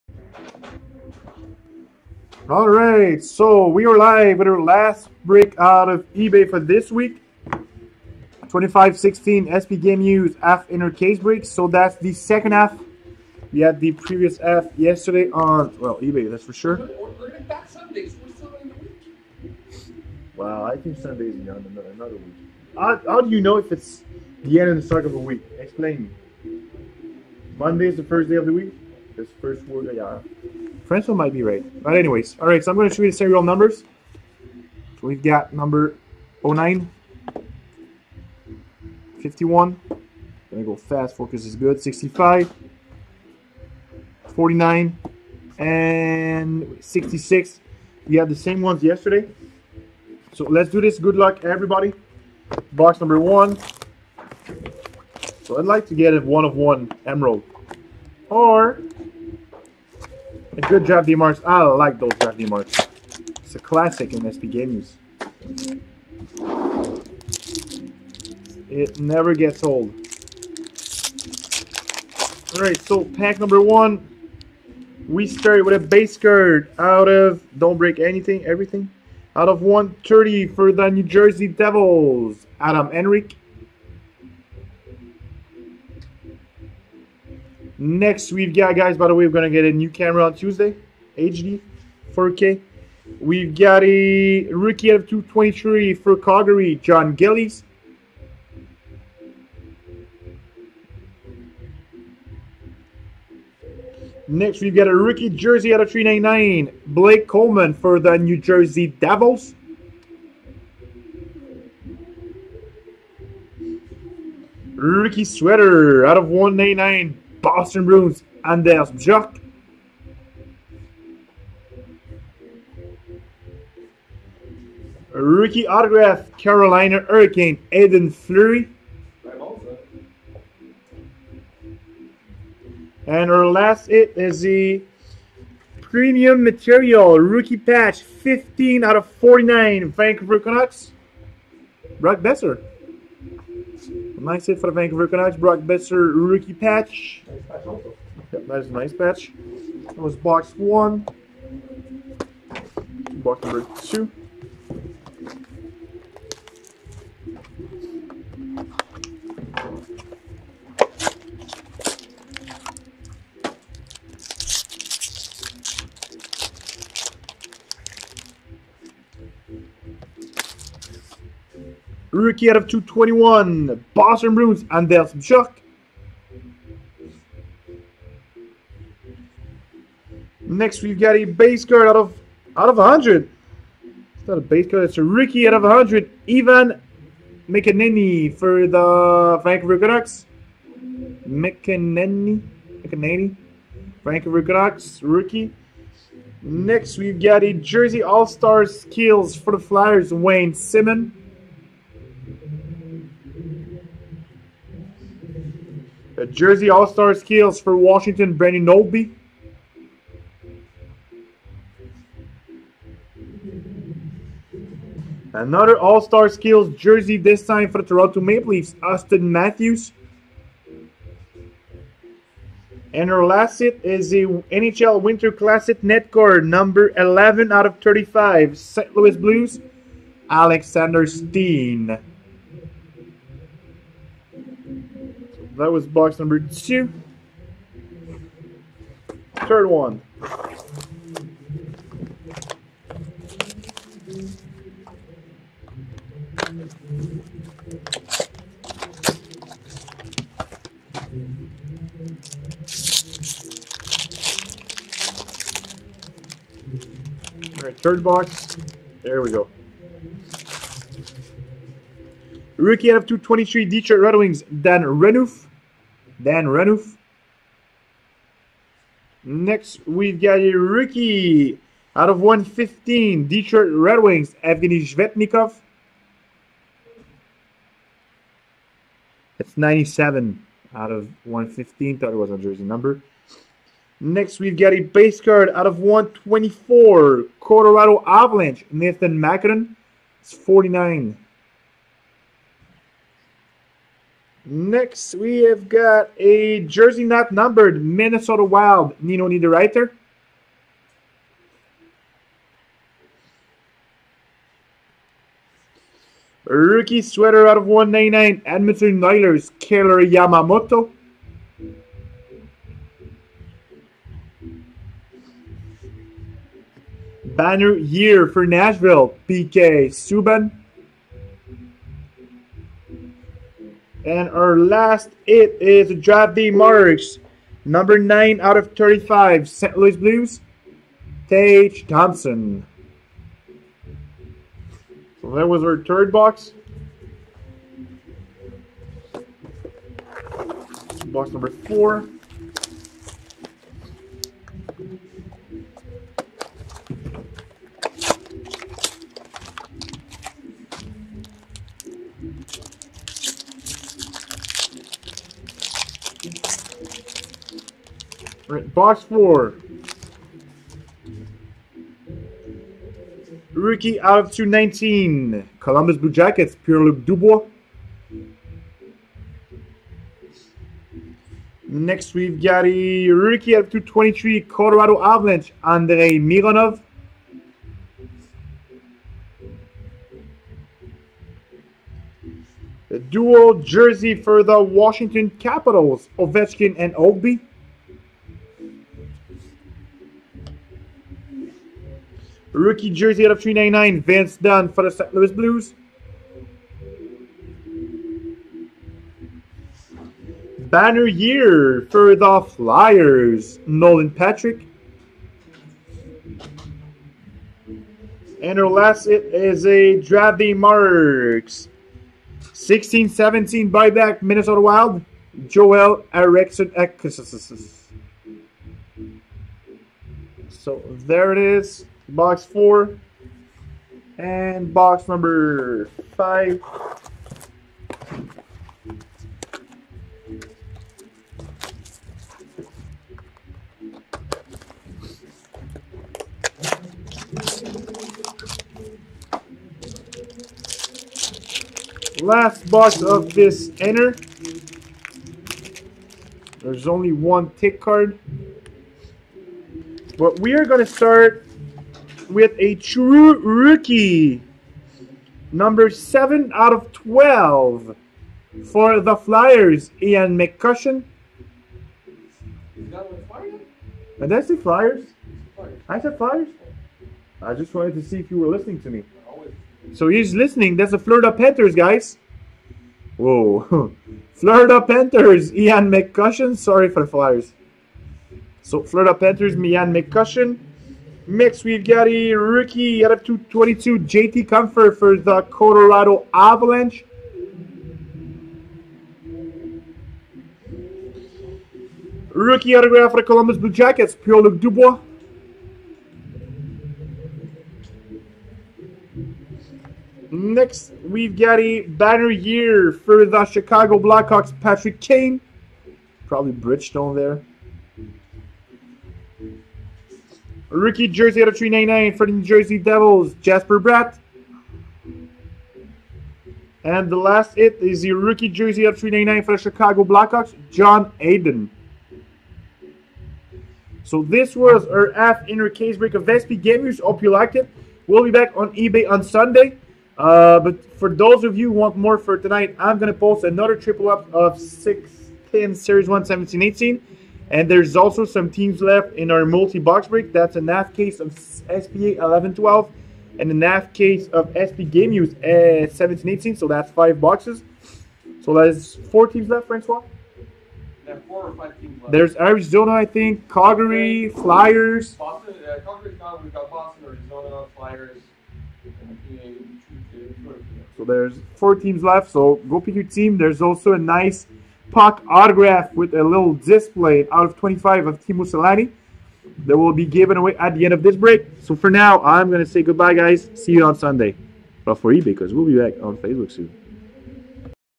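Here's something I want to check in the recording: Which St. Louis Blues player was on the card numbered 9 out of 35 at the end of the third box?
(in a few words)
Tage Thompson.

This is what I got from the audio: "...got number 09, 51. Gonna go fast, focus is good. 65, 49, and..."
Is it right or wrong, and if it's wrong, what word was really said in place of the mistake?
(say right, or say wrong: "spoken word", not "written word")
right.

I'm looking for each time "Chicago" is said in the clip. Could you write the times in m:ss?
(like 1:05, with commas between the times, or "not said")
8:23, 8:39.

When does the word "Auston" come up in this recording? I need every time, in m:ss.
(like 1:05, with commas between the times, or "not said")
3:38.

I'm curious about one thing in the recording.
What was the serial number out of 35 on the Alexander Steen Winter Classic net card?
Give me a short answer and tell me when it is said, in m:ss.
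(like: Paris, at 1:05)
11, at 3:46.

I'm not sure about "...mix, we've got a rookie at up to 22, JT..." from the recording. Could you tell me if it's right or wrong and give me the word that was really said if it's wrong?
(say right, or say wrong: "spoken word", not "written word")
right.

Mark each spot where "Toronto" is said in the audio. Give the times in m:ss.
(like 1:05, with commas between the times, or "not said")
3:37.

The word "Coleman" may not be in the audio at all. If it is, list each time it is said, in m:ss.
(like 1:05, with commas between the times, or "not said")
1:47.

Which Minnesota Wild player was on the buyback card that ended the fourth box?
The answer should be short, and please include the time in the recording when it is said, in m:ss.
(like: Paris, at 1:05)
Joel Eriksson, at 6:55.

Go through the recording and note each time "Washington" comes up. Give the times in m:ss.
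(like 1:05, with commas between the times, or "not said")
3:27, 6:24.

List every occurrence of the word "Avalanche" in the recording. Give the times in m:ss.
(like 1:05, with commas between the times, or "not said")
4:48, 6:15, 8:06.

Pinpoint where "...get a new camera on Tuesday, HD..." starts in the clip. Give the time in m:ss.
1:29.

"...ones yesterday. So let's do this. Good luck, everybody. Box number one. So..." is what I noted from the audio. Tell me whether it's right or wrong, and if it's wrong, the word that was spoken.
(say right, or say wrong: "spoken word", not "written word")
right.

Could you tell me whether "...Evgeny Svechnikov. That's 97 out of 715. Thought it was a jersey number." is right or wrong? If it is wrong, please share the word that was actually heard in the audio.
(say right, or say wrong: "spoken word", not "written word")
wrong: "115", not "715".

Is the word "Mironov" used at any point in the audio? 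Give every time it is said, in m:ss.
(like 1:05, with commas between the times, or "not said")
6:16.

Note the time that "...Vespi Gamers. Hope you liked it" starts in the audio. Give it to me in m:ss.
8:46.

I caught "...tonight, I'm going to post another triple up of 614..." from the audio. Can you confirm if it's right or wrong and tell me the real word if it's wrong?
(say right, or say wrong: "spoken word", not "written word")
wrong: "610", not "614".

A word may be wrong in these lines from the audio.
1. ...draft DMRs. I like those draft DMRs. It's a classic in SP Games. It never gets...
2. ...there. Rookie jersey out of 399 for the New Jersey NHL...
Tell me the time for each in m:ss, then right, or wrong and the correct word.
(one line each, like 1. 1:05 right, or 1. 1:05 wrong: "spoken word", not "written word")
1. 1:00 right
2. 8:27 wrong: "Devils", not "NHL".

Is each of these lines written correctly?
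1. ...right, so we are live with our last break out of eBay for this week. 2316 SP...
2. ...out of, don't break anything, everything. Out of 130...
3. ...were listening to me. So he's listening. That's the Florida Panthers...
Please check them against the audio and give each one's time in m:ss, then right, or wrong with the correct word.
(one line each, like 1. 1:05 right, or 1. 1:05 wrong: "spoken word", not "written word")
1. 0:02 wrong: "2516", not "2316"
2. 1:16 right
3. 7:48 right.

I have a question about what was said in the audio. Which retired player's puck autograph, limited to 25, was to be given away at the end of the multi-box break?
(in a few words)
Teemu Selanne.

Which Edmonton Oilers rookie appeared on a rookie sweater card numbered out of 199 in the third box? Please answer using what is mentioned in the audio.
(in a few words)
Kailer Yamamoto.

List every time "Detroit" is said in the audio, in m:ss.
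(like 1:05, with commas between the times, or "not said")
4:23, 4:33.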